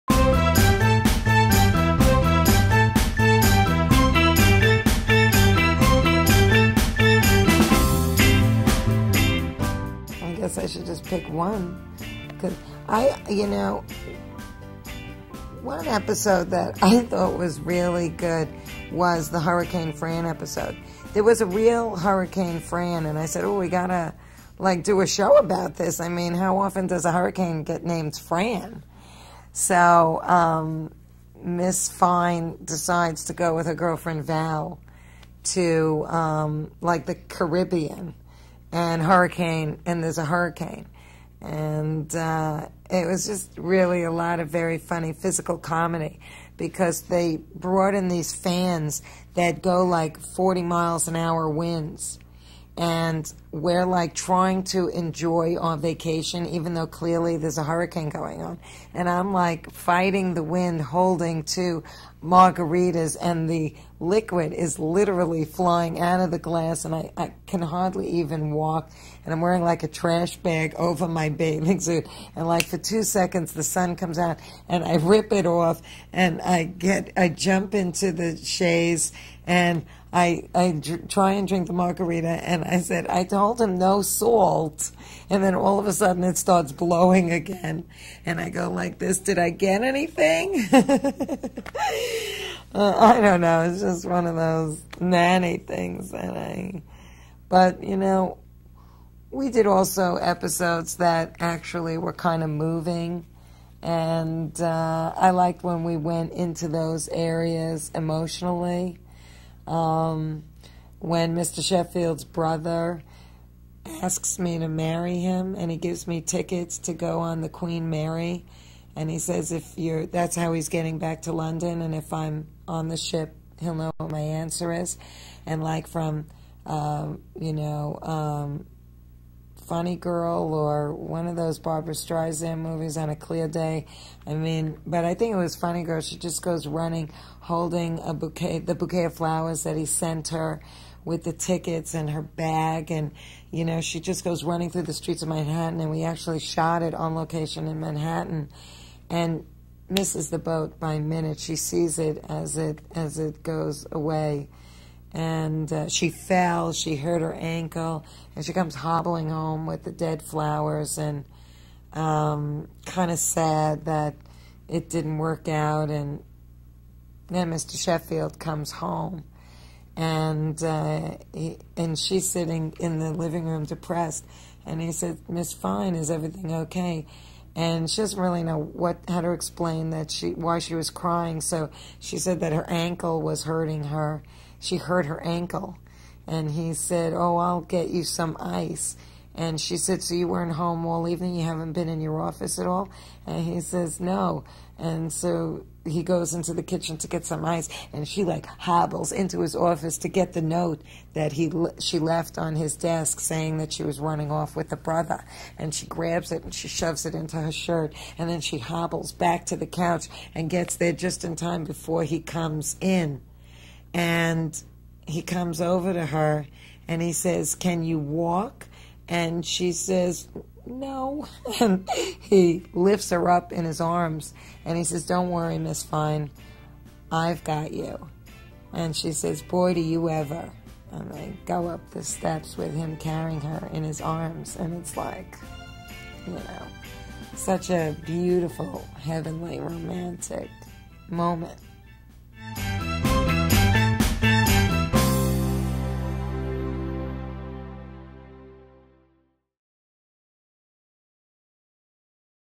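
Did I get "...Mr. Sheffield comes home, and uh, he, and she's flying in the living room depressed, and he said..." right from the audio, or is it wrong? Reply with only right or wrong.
wrong.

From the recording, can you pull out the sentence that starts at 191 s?
You haven't been in your office at all?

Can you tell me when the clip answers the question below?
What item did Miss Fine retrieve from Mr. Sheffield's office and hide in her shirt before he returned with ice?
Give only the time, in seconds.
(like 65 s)
200 s.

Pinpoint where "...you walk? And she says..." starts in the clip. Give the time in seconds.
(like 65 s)
217 s.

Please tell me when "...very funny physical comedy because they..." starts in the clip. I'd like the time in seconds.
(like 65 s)
44 s.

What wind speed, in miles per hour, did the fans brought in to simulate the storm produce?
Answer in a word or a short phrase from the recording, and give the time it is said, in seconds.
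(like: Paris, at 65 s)
40, at 50 s.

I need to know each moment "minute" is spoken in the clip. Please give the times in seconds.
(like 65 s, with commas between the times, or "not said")
150 s.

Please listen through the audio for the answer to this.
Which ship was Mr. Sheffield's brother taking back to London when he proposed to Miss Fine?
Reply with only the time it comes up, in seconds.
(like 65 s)
117 s.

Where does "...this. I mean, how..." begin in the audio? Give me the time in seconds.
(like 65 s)
25 s.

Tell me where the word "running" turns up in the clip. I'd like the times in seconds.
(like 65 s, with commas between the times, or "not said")
136 s, 144 s, 203 s.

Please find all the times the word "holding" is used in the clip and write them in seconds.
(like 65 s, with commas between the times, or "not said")
60 s, 137 s.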